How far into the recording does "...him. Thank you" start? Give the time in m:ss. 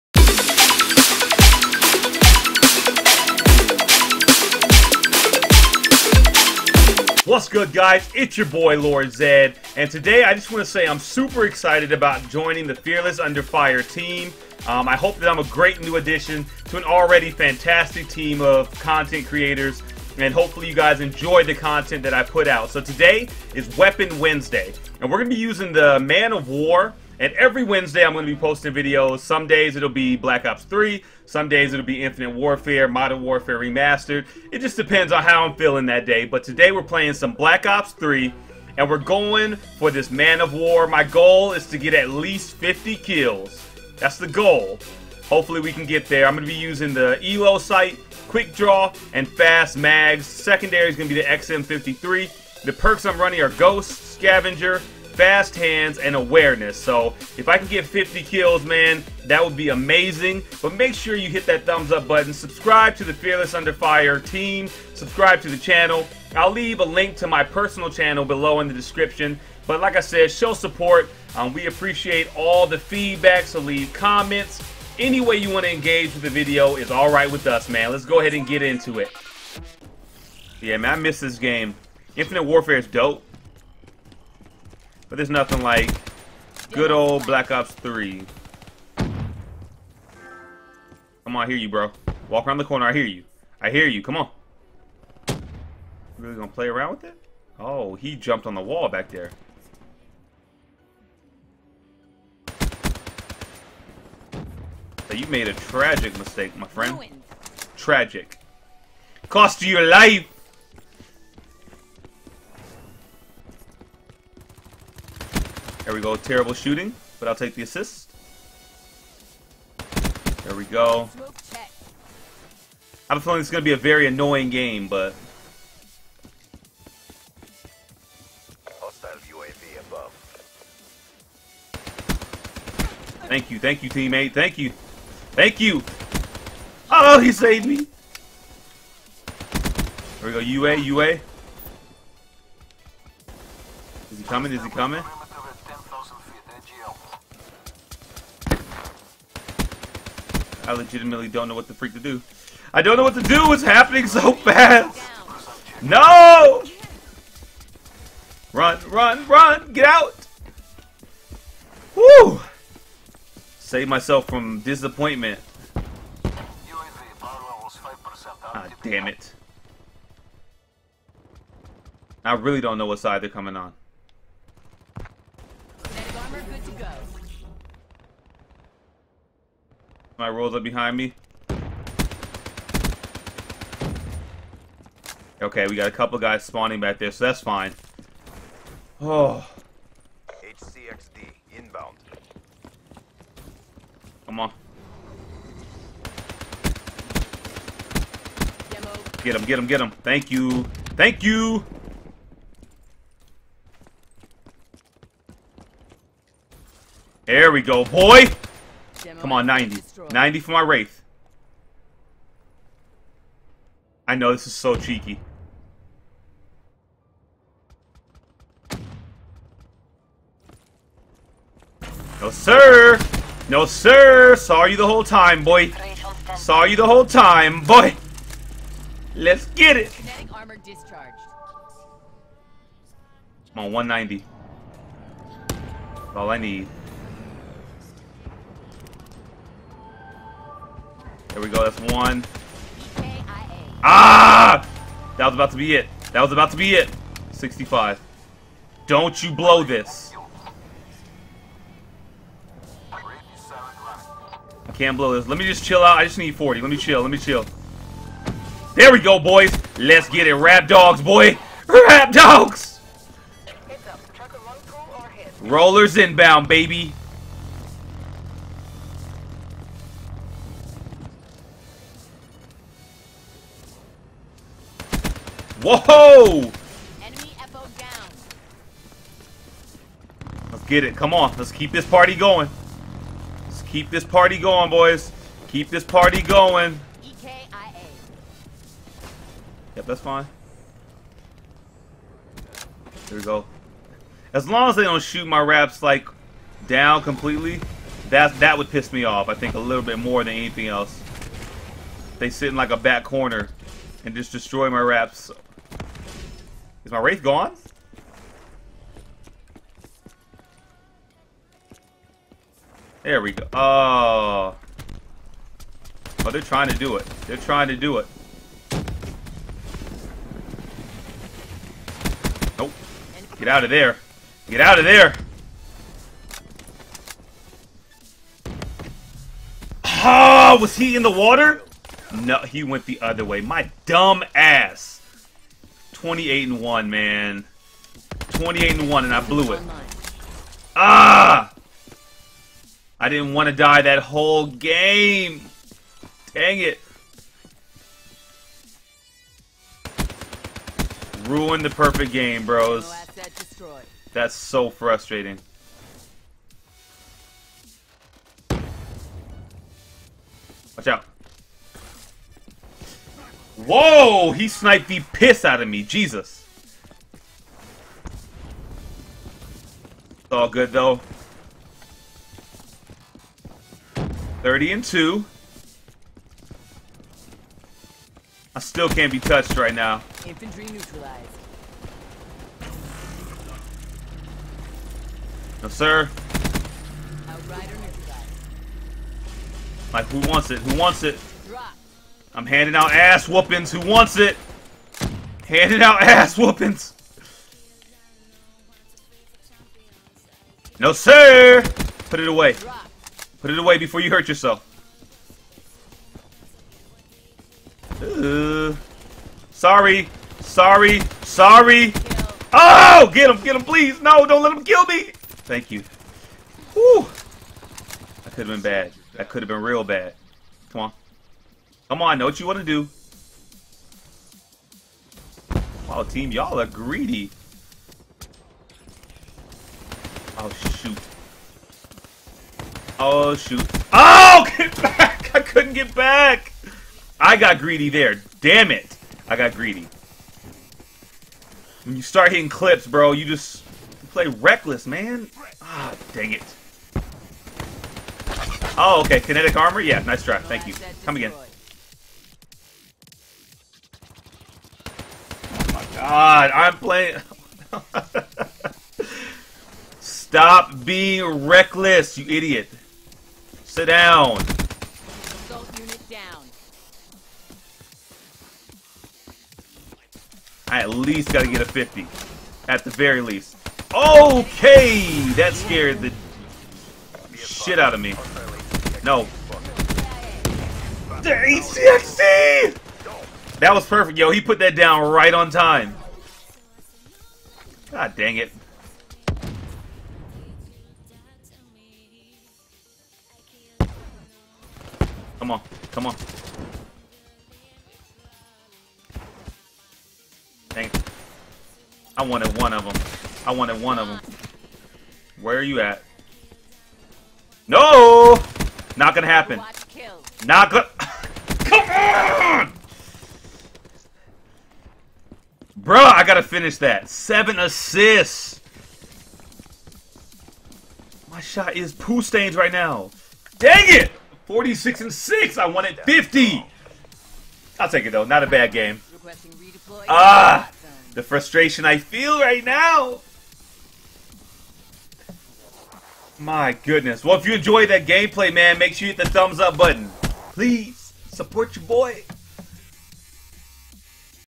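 3:19.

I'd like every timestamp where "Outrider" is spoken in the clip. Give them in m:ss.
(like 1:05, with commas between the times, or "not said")
6:27.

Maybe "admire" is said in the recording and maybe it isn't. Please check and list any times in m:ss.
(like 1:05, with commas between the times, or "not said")
not said.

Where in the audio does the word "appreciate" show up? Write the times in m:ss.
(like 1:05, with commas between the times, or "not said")
1:11.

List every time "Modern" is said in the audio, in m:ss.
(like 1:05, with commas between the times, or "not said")
0:32.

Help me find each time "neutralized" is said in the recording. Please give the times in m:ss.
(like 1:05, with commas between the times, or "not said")
6:20, 6:27.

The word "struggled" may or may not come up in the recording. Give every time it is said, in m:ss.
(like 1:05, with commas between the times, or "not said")
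not said.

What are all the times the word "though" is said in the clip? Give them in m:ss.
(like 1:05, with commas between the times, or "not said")
6:10, 8:48.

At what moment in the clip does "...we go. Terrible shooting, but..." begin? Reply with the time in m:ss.
1:55.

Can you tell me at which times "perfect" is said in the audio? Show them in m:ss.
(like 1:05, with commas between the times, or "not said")
5:51, 8:03.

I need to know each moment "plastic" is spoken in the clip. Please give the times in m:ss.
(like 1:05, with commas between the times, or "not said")
not said.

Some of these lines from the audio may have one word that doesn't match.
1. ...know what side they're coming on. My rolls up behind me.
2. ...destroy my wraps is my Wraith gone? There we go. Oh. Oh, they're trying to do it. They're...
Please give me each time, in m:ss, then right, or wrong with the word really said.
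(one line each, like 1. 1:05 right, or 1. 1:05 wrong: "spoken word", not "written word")
1. 2:52 right
2. 5:04 right.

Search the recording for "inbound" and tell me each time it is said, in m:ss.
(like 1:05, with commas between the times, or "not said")
3:11, 4:25.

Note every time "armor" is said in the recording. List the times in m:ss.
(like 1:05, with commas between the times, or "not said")
7:29.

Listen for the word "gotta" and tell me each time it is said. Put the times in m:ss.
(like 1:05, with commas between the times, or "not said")
7:51, 8:36.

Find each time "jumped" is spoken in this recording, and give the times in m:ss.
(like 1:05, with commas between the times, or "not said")
1:38.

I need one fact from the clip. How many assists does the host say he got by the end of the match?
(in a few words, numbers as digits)
7.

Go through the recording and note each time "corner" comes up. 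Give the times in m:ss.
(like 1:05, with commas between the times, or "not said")
1:32, 5:03.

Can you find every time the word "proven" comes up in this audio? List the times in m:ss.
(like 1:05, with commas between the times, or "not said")
not said.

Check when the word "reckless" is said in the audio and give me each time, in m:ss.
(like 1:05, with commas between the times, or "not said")
7:24, 7:41.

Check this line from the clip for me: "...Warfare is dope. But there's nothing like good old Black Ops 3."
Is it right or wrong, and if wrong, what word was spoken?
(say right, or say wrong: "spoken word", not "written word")
right.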